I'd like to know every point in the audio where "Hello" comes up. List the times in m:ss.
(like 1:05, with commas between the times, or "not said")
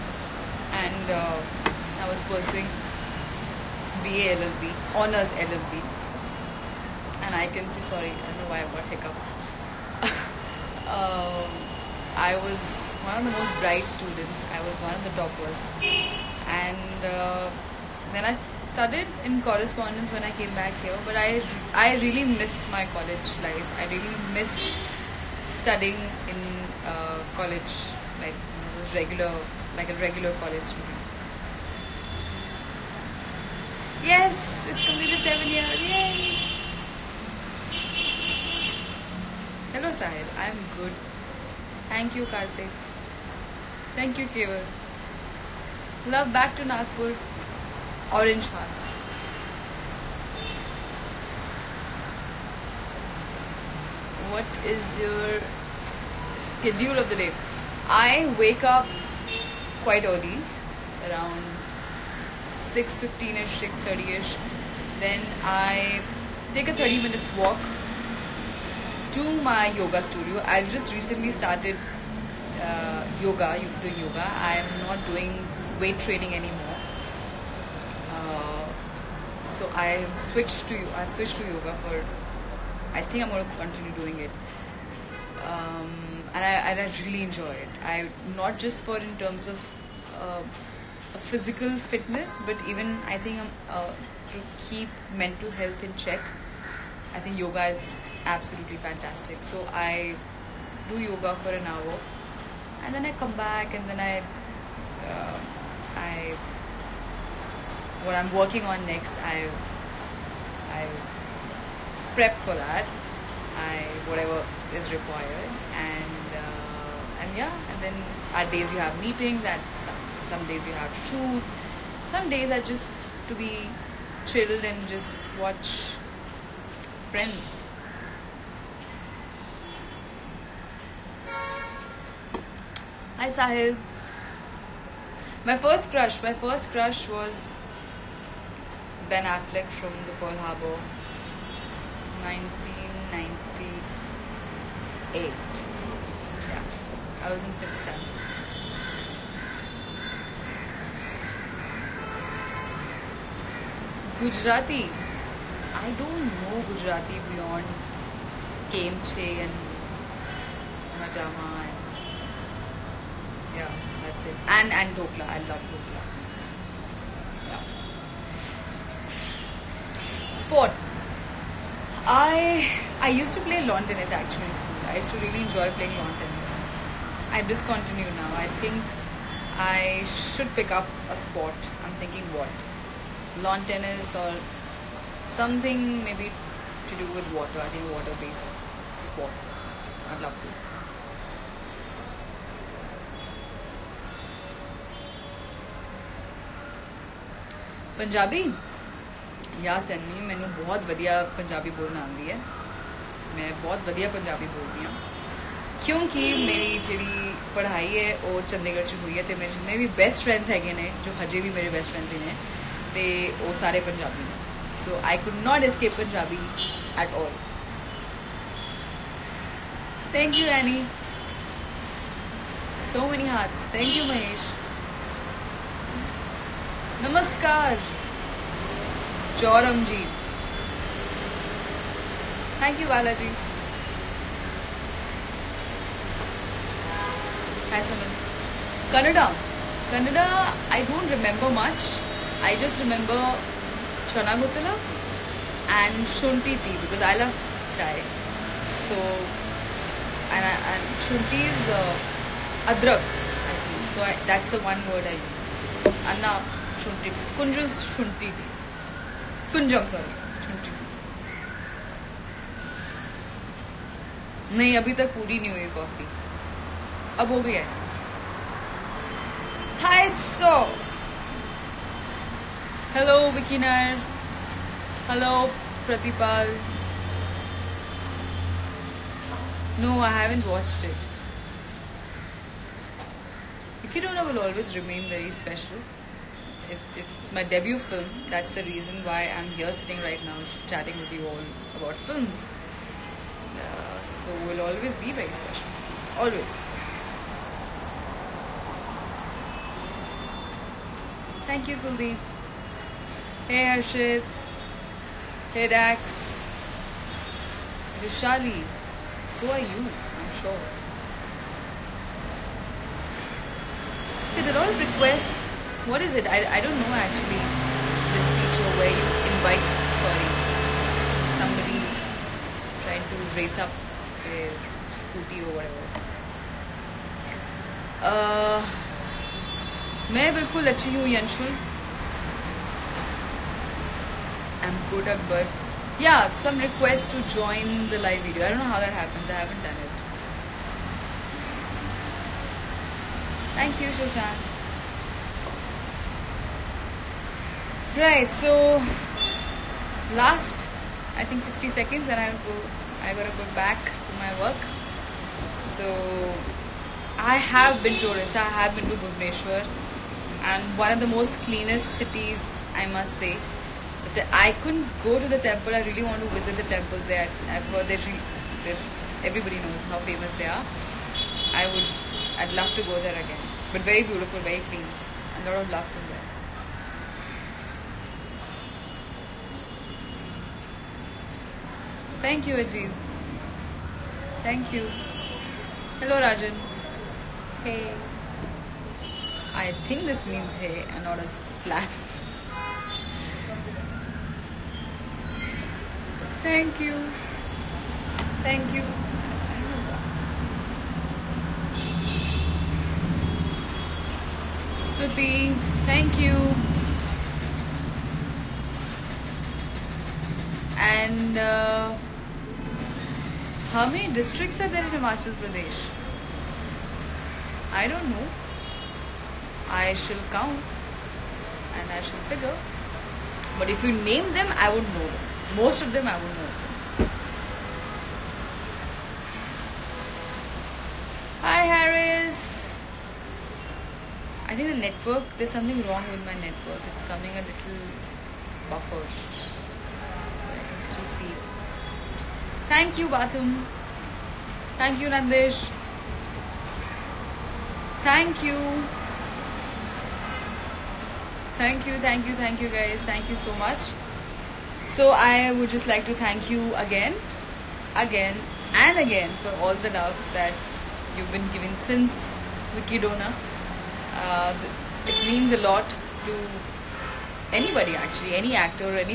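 0:39, 6:26.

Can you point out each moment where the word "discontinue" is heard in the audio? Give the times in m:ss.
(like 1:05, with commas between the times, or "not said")
2:57.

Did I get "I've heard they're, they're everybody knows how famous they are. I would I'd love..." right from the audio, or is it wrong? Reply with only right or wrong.
right.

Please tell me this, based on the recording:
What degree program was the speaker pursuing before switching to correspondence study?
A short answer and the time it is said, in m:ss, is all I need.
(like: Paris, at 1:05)
BA LLB, at 0:04.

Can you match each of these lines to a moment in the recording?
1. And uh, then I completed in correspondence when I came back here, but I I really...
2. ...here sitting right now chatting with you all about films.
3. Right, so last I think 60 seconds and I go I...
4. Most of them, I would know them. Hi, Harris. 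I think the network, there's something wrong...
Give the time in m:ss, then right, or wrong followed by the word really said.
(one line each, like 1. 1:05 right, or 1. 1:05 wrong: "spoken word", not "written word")
1. 0:16 wrong: "studied", not "completed"
2. 4:49 right
3. 5:47 right
4. 7:05 right.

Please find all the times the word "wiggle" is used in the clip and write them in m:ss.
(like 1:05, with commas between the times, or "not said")
not said.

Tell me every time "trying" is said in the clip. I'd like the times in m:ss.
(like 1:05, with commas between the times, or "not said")
5:22.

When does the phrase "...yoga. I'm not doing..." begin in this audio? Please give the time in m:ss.
1:13.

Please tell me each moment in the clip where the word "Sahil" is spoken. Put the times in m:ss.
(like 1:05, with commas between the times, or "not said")
0:40, 2:13.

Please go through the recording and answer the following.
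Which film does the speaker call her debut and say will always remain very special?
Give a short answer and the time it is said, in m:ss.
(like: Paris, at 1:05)
Vicky Donor, at 7:42.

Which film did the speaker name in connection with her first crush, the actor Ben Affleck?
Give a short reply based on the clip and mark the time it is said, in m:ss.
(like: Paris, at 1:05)
Pearl Harbor, at 2:20.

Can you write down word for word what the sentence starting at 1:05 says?
Then I take a 30 minutes walk to my yoga studio.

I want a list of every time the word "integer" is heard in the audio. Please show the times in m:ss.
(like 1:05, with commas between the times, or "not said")
not said.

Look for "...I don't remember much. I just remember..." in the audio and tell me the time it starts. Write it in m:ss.
4:00.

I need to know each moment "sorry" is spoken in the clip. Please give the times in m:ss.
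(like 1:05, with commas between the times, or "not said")
0:07, 5:20.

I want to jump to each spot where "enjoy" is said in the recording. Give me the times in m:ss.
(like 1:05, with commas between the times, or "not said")
1:27, 2:55.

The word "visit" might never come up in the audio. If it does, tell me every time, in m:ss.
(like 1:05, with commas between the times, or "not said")
6:06.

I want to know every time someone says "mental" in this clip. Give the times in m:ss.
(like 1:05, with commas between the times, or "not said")
1:35.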